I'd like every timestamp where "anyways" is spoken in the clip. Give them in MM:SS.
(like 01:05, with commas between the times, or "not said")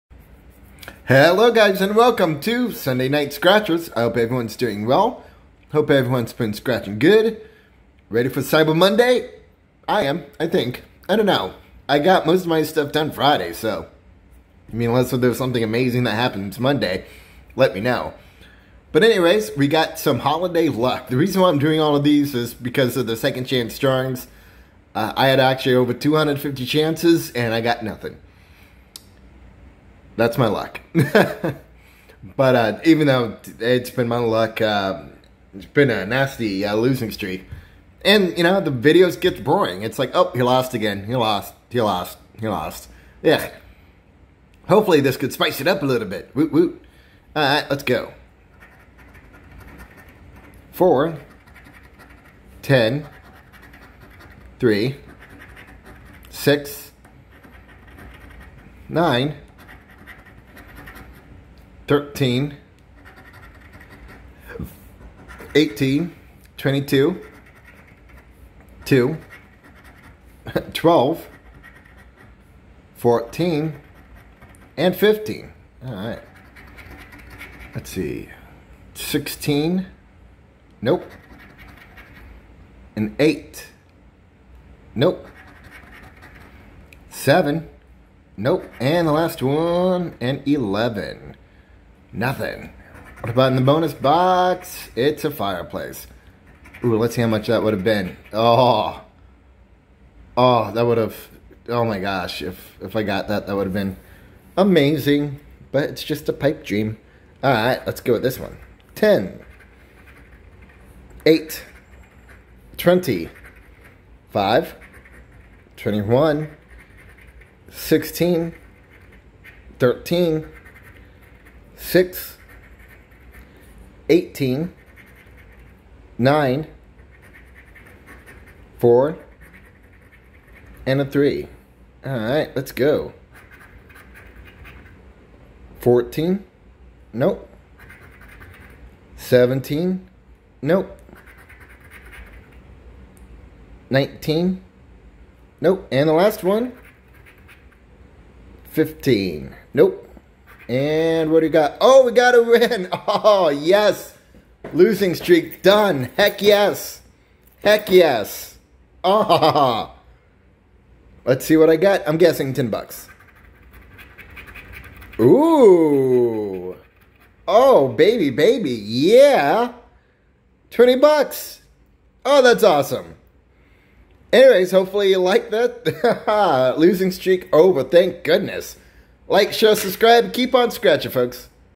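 00:19, 02:54.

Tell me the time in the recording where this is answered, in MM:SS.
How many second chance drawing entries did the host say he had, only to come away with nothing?
00:25.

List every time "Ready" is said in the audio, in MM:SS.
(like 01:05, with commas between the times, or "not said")
00:08.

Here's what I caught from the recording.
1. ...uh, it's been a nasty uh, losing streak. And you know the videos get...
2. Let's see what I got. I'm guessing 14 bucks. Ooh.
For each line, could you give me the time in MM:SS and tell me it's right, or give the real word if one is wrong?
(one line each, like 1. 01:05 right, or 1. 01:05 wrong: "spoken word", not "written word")
1. 00:34 right
2. 02:41 wrong: "10", not "14".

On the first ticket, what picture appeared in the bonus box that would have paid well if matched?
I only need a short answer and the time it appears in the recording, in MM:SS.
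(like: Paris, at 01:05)
a fireplace, at 01:35.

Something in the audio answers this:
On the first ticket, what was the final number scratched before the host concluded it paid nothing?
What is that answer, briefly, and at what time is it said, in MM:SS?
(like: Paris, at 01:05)
11, at 01:30.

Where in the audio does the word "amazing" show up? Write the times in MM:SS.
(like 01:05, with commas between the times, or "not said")
00:15, 01:44.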